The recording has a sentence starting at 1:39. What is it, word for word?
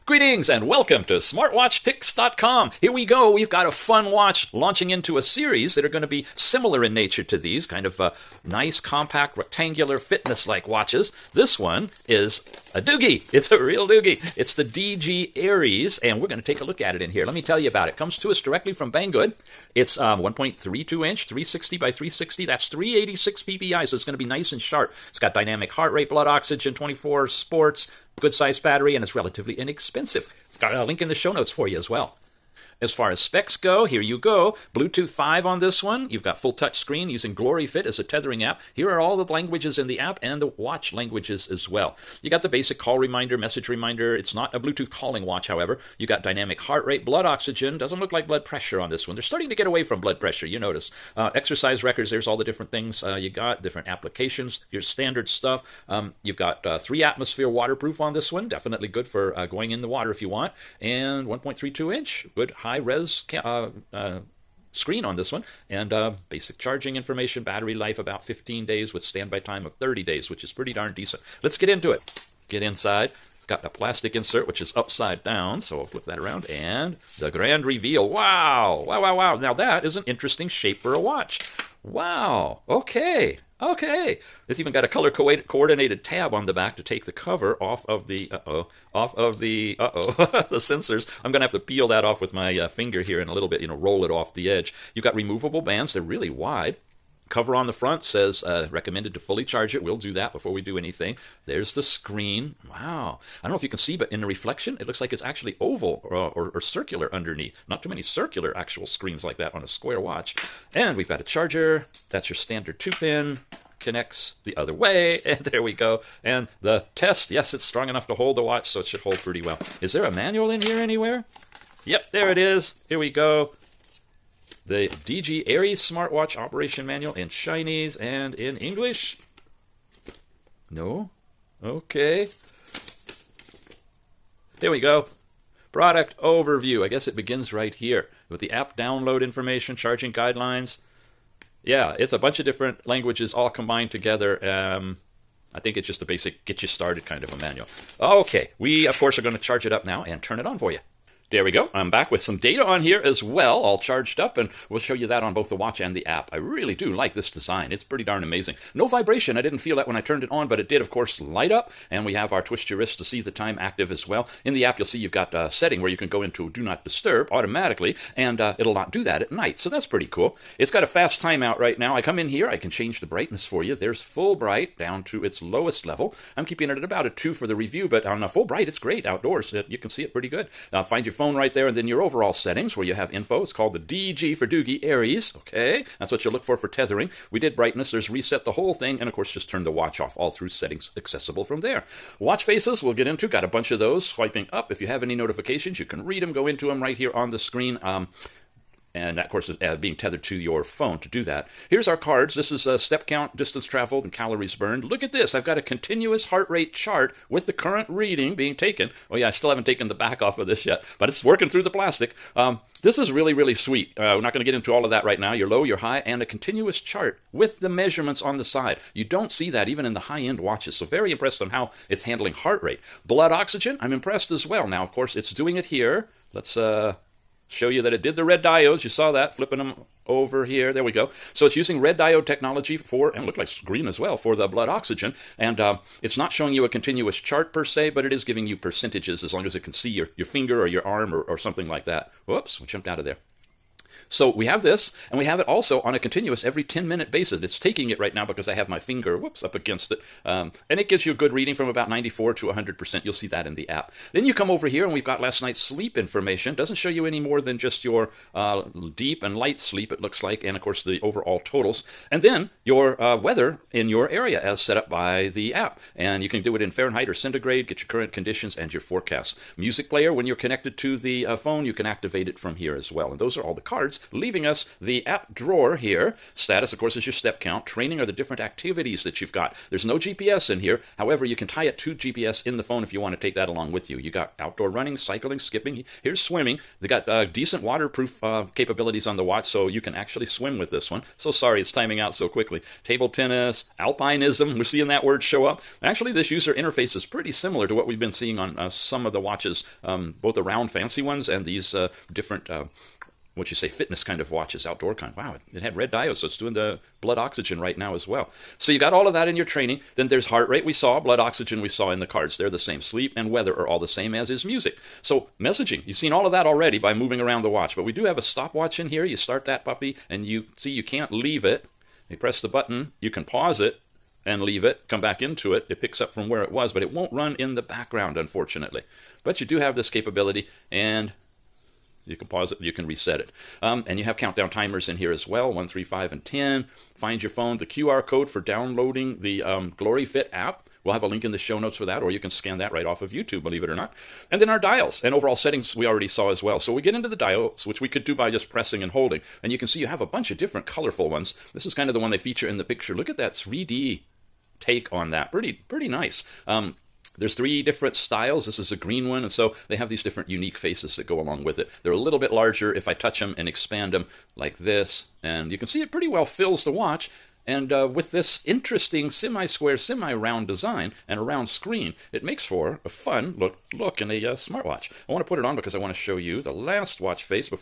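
We'll do that before we do anything.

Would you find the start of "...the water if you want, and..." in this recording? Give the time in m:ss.
0:59.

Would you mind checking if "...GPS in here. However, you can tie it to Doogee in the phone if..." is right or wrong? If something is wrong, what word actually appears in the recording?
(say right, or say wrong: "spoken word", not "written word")
wrong: "GPS", not "Doogee".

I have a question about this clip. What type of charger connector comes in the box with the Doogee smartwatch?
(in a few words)
standard two pin.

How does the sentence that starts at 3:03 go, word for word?
It's called the DG for Doogee Ares.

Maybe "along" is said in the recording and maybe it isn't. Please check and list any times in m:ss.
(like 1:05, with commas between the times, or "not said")
4:43, 6:01.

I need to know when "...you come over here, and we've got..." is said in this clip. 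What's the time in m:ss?
4:14.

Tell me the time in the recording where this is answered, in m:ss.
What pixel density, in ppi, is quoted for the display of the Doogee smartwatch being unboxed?
0:22.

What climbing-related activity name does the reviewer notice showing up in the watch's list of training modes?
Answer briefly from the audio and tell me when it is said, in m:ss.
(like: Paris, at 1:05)
alpinism, at 4:53.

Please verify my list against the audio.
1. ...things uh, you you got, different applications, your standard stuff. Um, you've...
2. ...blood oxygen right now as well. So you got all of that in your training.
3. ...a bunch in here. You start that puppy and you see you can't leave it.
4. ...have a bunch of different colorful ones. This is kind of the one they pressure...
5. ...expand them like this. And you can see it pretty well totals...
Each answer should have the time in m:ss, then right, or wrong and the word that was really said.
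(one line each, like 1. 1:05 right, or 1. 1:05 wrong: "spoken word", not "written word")
1. 0:52 right
2. 5:07 right
3. 5:18 wrong: "stopwatch", not "bunch"
4. 5:49 wrong: "feature", not "pressure"
5. 6:03 wrong: "fills", not "totals".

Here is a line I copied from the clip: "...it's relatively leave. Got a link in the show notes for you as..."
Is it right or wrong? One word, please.
wrong.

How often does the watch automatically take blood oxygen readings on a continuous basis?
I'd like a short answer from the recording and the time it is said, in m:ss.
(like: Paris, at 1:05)
every 10 minutes, at 4:06.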